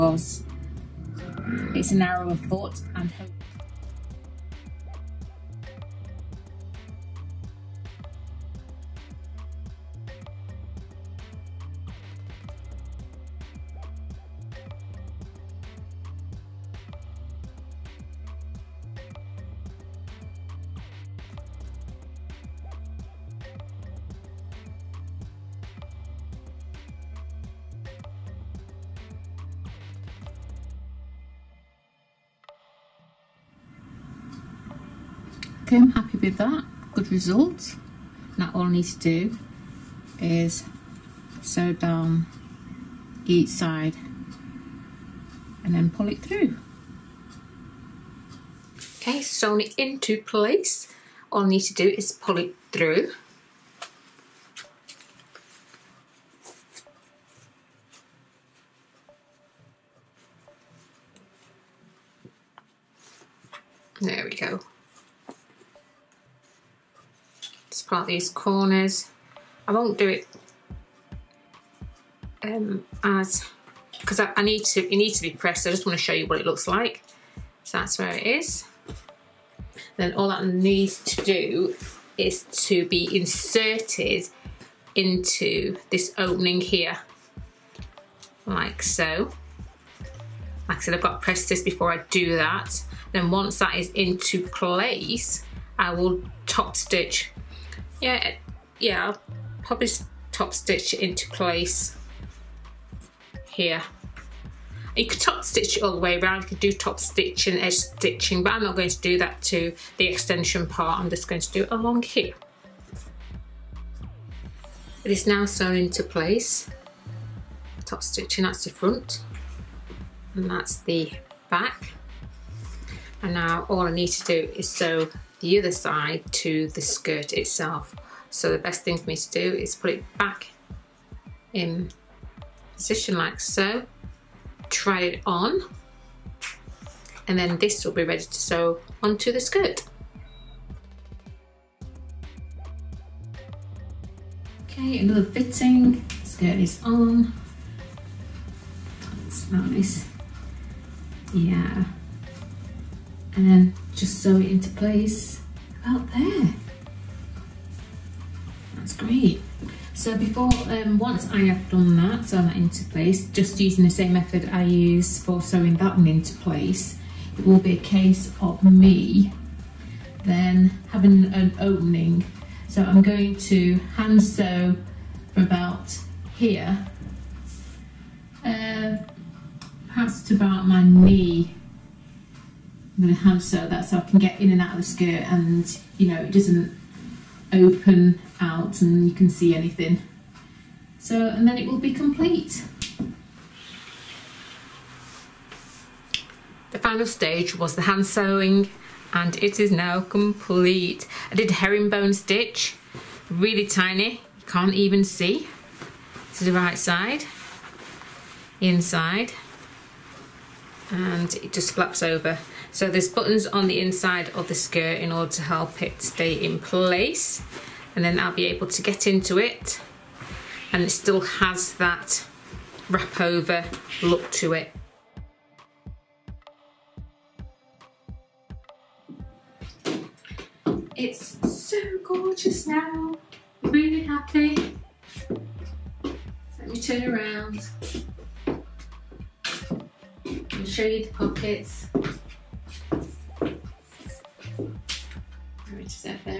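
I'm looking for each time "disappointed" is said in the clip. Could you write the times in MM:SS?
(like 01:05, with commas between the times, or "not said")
not said.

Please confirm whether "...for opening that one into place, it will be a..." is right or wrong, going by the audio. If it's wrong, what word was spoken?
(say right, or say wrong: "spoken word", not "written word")
wrong: "sewing", not "opening".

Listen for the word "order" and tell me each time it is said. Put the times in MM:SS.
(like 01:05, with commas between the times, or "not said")
03:35.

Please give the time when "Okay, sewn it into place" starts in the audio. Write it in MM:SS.
00:49.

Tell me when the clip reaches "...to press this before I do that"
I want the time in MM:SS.
01:31.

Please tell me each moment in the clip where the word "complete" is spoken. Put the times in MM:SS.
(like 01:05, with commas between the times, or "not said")
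03:11, 03:19.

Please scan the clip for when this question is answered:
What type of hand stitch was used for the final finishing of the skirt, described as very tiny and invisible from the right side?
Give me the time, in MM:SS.
03:21.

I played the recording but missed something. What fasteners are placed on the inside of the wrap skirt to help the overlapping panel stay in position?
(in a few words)
buttons.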